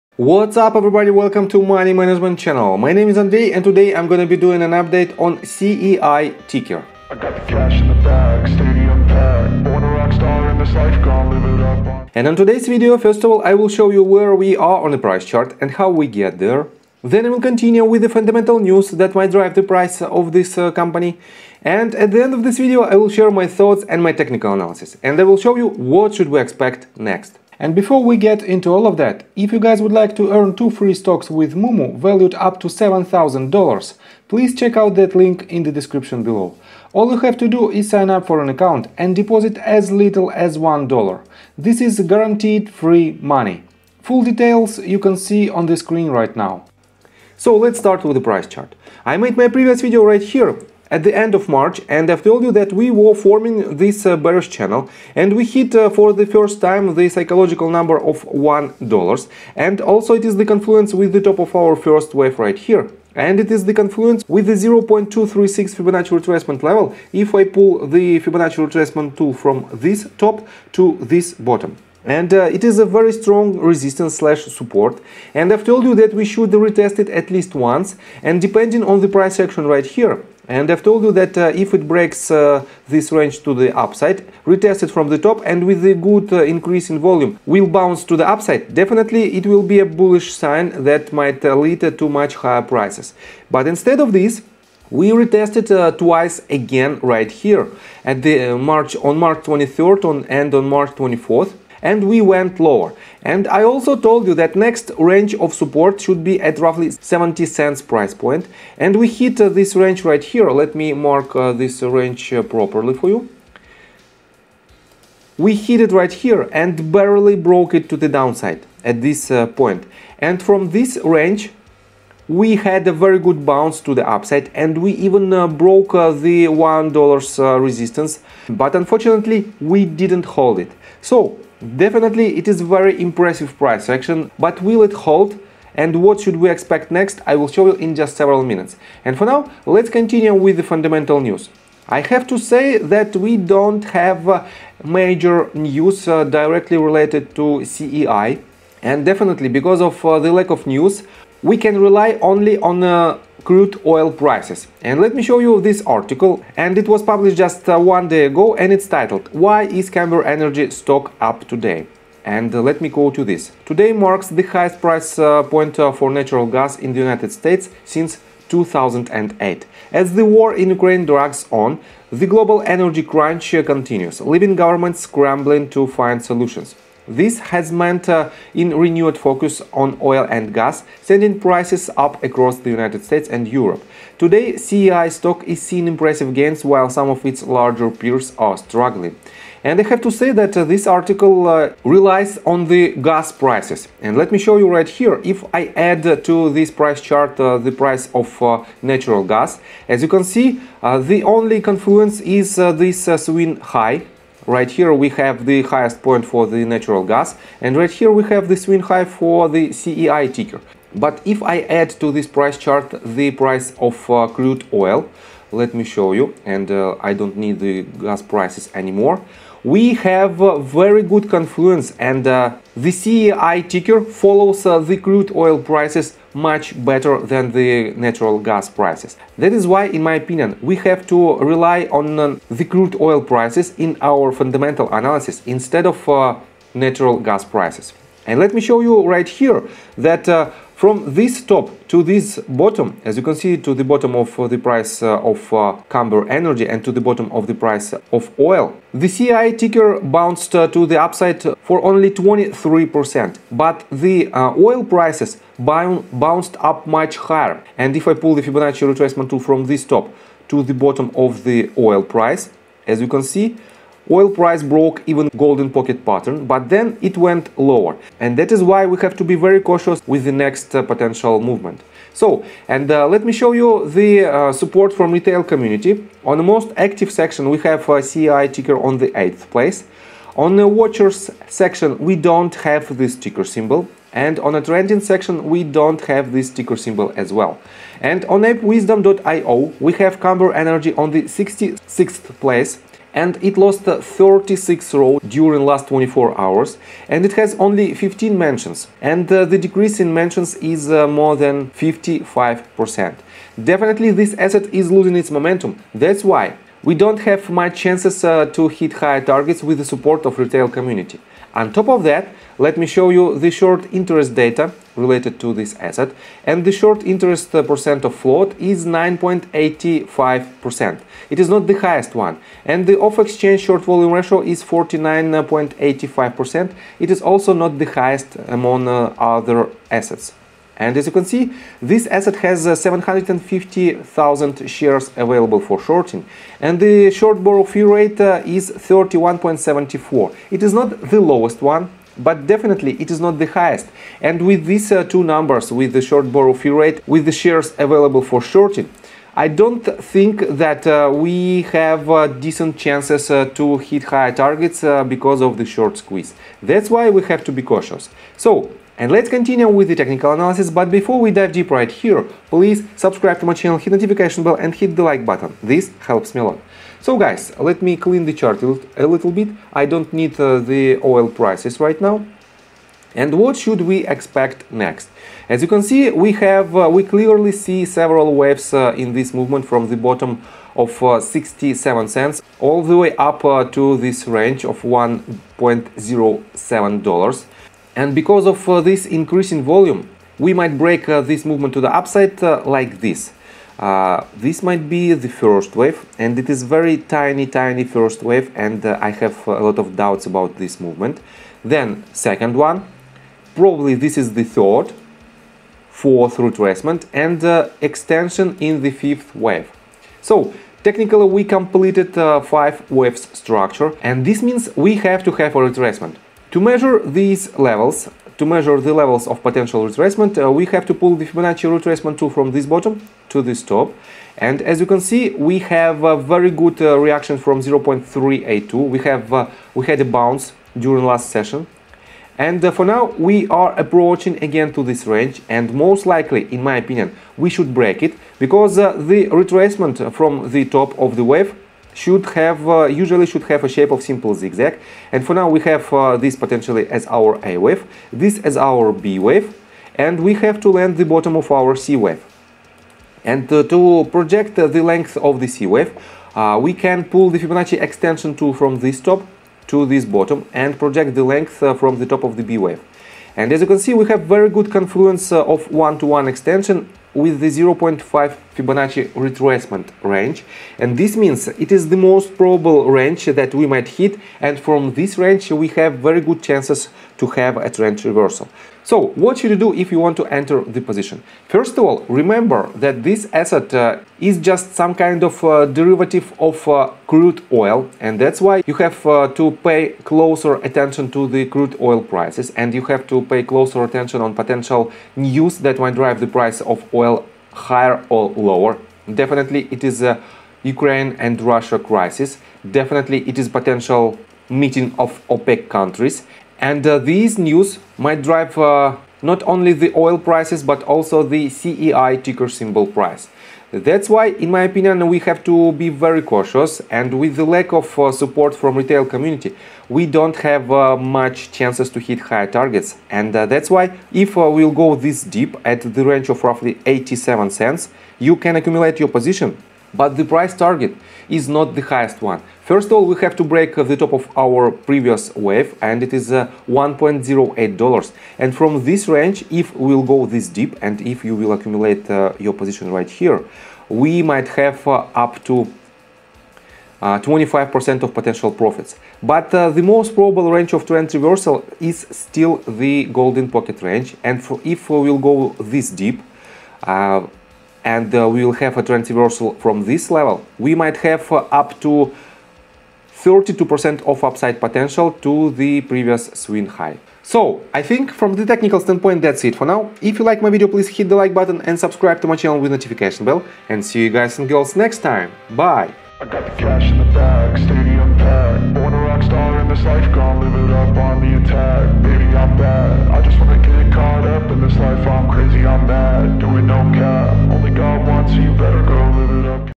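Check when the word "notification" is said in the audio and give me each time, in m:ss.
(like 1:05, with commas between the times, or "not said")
6:03, 9:32.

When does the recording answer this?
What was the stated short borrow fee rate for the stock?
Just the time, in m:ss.
5:38.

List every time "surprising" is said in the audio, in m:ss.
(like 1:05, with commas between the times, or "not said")
not said.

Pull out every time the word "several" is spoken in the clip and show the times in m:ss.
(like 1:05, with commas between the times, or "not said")
2:18, 6:17.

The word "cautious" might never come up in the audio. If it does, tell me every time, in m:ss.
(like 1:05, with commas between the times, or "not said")
4:29, 5:57, 8:36.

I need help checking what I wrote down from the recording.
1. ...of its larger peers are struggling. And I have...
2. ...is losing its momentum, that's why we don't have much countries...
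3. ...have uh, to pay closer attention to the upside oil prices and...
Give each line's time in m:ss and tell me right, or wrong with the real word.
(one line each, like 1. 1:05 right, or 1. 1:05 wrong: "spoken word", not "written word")
1. 3:07 right
2. 5:04 wrong: "chances", not "countries"
3. 8:08 wrong: "crude", not "upside".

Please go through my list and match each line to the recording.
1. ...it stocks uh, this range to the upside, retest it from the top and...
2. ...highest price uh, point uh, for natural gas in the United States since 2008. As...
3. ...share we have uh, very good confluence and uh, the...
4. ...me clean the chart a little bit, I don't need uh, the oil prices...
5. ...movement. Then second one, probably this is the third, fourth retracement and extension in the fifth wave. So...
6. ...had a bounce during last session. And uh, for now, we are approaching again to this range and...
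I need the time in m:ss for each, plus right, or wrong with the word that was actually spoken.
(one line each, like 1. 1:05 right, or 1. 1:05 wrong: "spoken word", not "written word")
1. 1:21 wrong: "breaks", not "stocks"
2. 2:44 right
3. 3:38 wrong: "anymore", not "share"
4. 6:07 right
5. 6:40 right
6. 7:09 right.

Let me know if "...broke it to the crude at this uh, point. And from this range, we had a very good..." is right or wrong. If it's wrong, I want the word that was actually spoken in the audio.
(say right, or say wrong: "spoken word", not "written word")
wrong: "downside", not "crude".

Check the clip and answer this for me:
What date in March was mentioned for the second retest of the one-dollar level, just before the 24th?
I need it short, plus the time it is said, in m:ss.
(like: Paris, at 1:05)
March 23rd, at 1:39.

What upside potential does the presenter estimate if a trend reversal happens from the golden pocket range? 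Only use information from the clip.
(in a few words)
32%.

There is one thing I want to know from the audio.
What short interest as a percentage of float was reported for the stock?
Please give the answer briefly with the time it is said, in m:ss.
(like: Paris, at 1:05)
9.85%, at 5:18.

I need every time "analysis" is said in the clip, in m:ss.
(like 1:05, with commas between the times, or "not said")
0:24, 3:54, 6:00.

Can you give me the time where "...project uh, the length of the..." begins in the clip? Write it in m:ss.
7:34.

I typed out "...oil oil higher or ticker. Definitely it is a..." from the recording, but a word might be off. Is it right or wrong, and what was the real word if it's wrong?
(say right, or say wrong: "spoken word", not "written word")
wrong: "lower", not "ticker".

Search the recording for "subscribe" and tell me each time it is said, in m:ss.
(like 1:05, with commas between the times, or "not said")
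6:02, 9:31.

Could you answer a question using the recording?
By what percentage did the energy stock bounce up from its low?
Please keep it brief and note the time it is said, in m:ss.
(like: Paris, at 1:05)
23%, at 4:12.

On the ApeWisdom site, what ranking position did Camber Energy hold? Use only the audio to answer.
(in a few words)
66th.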